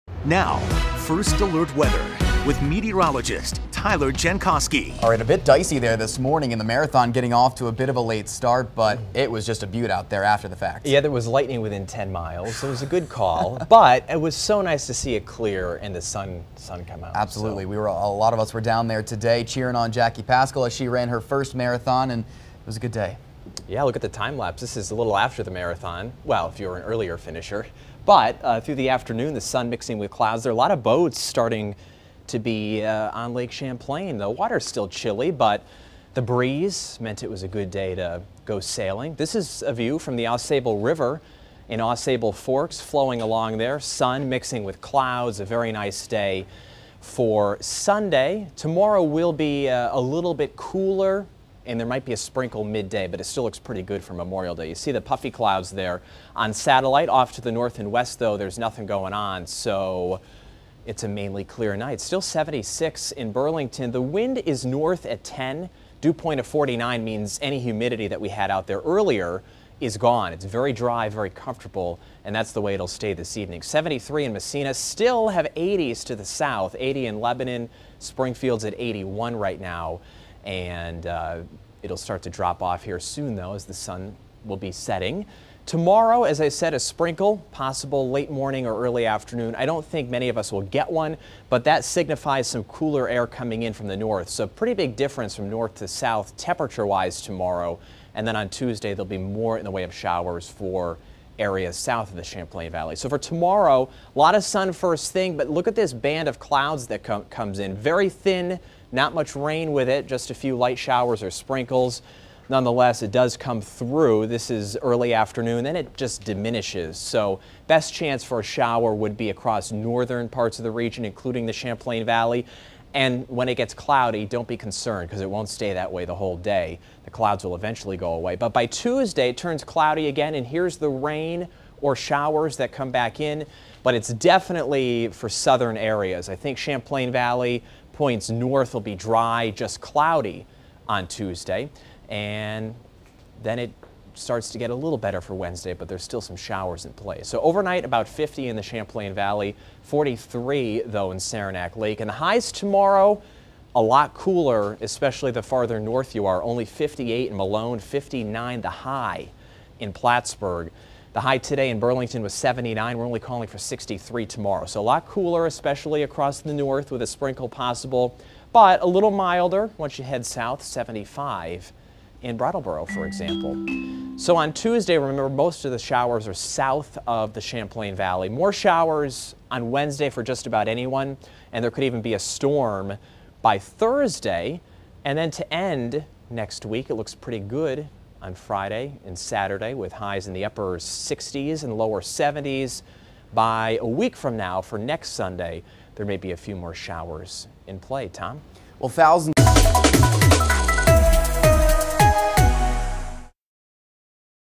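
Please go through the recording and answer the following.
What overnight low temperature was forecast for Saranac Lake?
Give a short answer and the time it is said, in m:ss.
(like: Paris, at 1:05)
43, at 2:29.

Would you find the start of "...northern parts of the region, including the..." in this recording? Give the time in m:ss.
1:59.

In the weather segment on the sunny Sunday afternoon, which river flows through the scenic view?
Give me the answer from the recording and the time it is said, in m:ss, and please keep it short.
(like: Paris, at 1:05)
Ausable River, at 0:40.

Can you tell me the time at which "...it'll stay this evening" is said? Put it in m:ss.
1:12.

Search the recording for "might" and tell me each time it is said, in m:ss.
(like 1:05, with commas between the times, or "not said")
0:51.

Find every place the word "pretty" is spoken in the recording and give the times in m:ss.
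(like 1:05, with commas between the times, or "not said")
0:53, 1:34, 3:07.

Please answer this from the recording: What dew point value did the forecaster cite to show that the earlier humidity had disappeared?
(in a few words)
49.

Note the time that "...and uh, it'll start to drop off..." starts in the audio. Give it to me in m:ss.
1:20.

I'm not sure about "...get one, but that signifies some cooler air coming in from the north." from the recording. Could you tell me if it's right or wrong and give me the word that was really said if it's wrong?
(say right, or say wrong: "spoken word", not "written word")
right.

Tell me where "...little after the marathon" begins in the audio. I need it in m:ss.
0:24.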